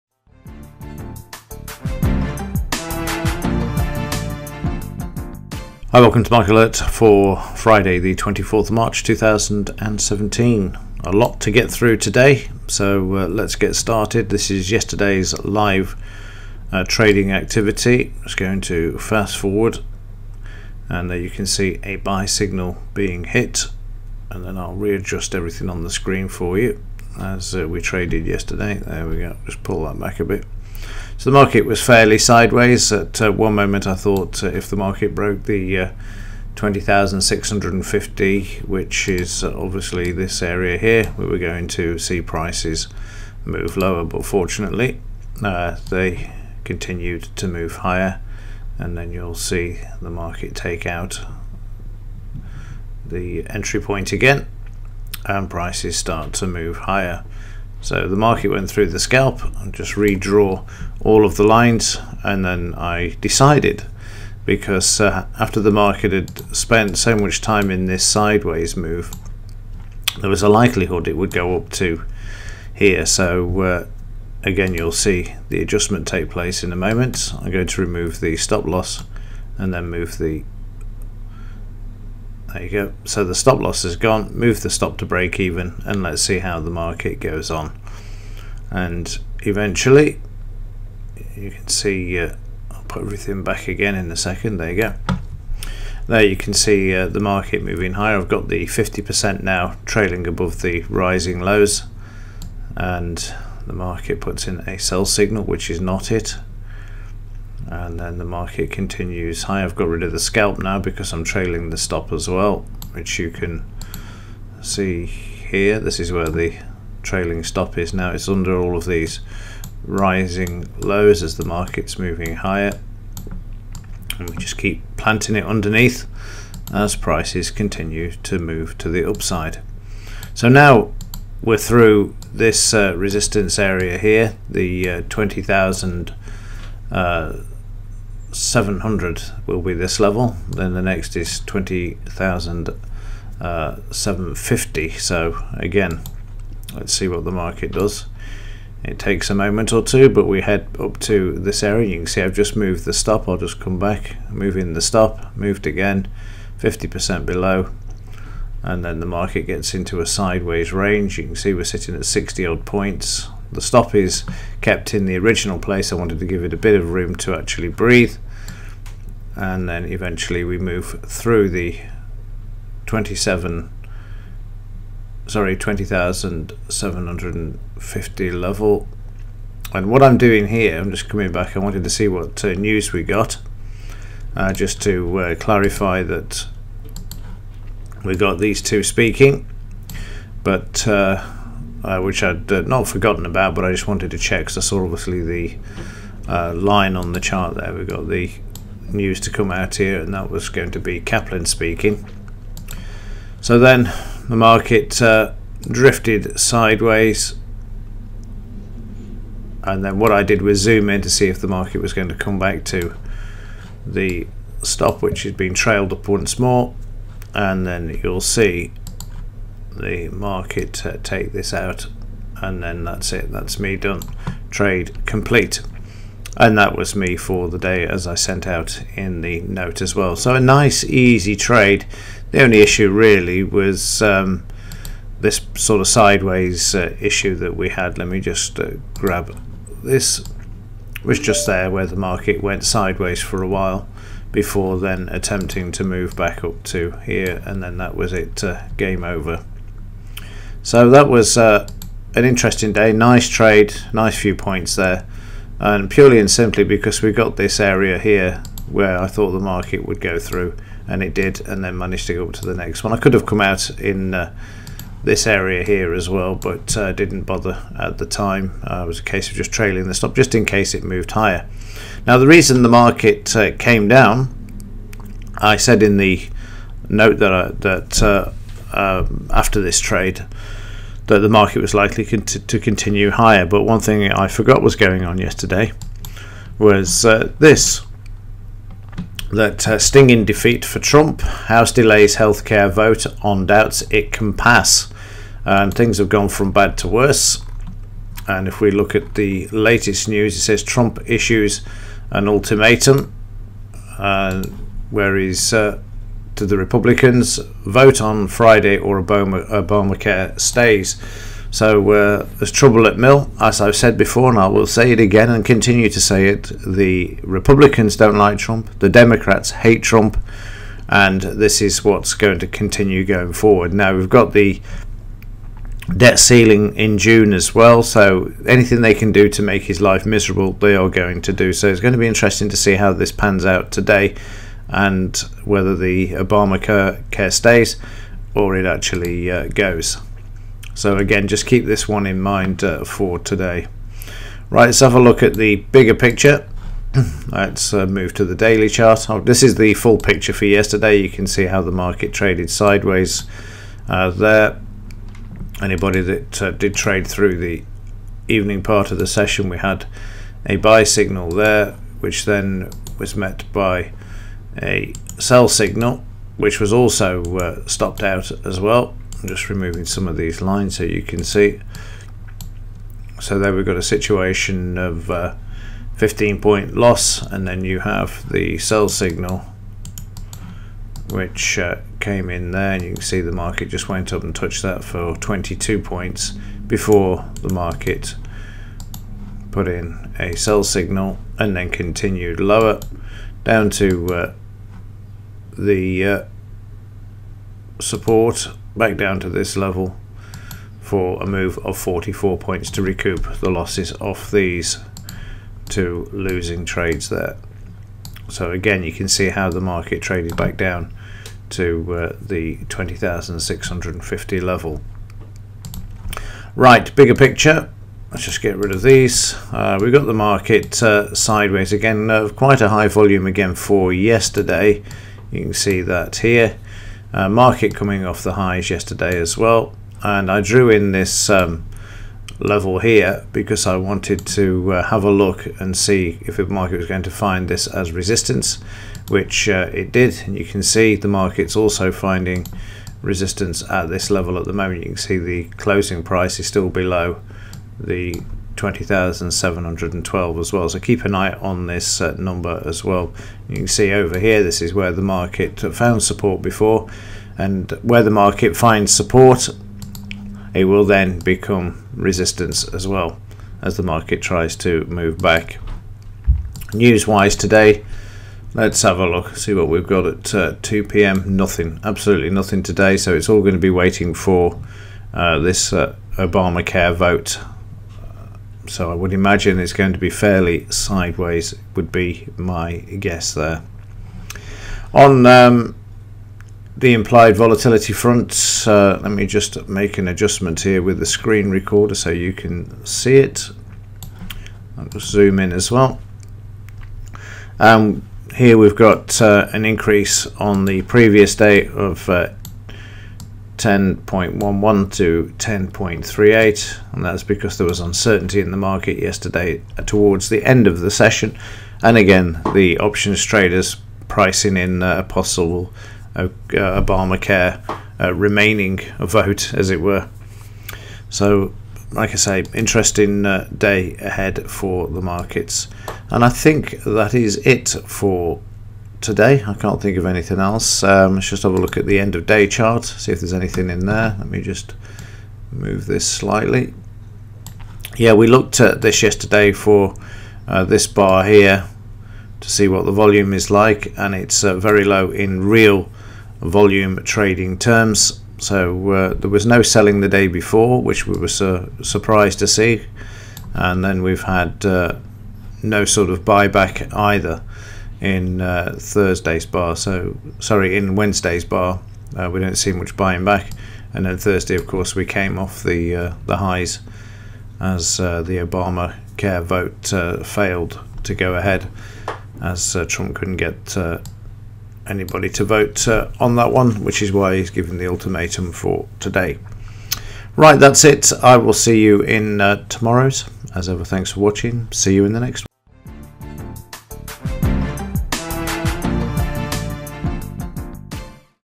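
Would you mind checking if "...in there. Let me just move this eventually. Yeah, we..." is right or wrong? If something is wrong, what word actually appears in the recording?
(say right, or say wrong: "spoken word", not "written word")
wrong: "slightly", not "eventually".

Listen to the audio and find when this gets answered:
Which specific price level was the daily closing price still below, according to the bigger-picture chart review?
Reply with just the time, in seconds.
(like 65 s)
448 s.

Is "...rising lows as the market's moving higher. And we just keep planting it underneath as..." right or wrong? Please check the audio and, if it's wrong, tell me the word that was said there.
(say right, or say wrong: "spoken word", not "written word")
right.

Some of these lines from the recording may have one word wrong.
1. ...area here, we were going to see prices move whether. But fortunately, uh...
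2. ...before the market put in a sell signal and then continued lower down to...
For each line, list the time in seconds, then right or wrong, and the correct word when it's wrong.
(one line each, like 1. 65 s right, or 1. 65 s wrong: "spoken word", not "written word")
1. 40 s wrong: "lower", not "whether"
2. 386 s right.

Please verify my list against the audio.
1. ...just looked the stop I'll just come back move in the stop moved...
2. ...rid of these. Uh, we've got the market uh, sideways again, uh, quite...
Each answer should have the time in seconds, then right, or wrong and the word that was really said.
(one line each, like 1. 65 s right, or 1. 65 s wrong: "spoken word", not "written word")
1. 152 s wrong: "moved", not "looked"
2. 418 s right.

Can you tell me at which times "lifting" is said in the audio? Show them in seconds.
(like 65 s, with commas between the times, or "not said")
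not said.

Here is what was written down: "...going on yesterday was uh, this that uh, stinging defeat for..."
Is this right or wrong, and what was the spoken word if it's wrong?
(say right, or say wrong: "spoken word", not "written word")
right.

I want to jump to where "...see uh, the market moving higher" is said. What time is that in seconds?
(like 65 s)
96 s.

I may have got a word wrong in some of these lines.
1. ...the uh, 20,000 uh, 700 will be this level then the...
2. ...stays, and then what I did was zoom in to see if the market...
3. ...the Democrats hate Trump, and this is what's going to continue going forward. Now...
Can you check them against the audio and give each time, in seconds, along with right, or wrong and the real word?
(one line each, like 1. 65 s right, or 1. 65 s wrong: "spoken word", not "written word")
1. 134 s right
2. 206 s wrong: "sideways", not "stays"
3. 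318 s right.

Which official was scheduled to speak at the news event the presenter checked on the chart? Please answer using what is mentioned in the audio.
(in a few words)
Kaplan.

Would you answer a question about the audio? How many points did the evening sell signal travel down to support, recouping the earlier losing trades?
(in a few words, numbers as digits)
44.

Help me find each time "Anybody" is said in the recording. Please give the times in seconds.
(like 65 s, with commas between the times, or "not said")
355 s, 574 s.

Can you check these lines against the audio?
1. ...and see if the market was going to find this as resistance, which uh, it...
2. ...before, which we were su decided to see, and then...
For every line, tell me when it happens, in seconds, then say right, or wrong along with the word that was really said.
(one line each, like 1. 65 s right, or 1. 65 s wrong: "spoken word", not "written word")
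1. 435 s right
2. 550 s wrong: "surprised", not "decided".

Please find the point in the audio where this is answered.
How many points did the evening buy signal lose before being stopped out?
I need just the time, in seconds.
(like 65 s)
375 s.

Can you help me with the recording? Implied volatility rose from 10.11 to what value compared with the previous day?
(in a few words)
10.38.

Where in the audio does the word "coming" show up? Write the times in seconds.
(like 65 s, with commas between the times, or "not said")
181 s, 427 s.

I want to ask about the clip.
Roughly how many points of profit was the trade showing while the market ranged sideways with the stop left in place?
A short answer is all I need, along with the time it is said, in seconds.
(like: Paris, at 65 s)
60, at 162 s.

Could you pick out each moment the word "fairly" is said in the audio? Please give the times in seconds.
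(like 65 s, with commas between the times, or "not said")
31 s, 480 s.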